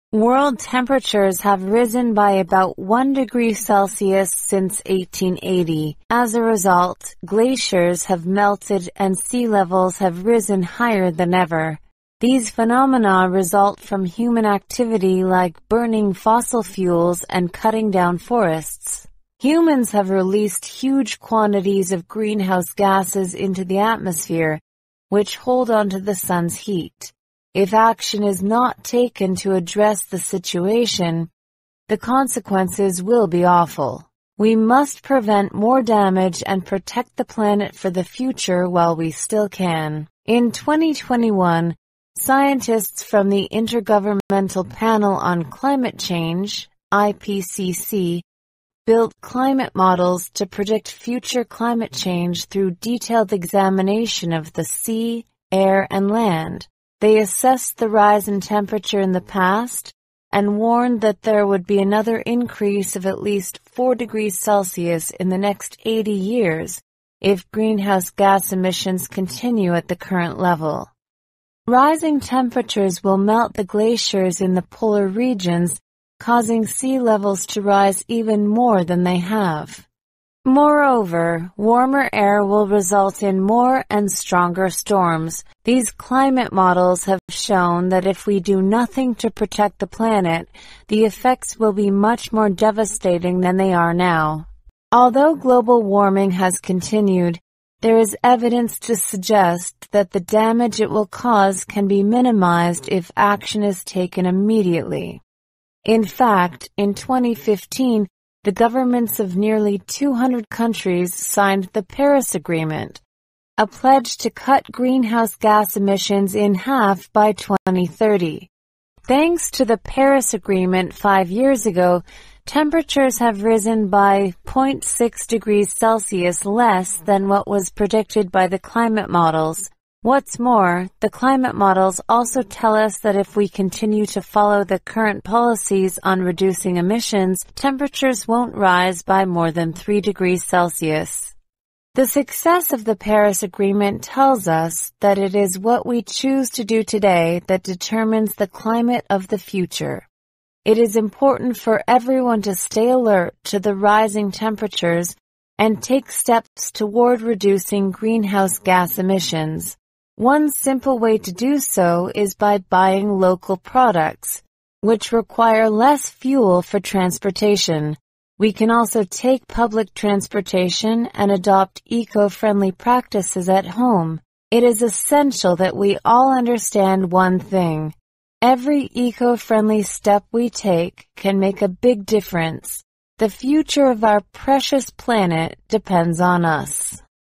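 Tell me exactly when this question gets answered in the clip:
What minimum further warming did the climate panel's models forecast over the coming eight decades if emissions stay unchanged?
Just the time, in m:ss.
1:03.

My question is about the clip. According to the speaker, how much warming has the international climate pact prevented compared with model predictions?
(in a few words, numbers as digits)
0.6 degrees Celsius.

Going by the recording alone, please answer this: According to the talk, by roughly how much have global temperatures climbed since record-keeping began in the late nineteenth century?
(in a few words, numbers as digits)
1 degree Celsius.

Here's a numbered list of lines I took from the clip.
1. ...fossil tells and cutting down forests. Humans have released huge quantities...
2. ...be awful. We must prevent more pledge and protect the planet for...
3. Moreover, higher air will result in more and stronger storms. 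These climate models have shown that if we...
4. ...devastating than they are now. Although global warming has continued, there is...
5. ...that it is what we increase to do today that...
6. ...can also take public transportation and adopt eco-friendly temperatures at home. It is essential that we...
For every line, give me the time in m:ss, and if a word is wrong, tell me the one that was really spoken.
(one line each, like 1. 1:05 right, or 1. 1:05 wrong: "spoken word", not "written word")
1. 0:16 wrong: "fuels", not "tells"
2. 0:33 wrong: "damage", not "pledge"
3. 1:20 wrong: "warmer", not "higher"
4. 1:32 right
5. 2:25 wrong: "choose", not "increase"
6. 2:48 wrong: "practices", not "temperatures".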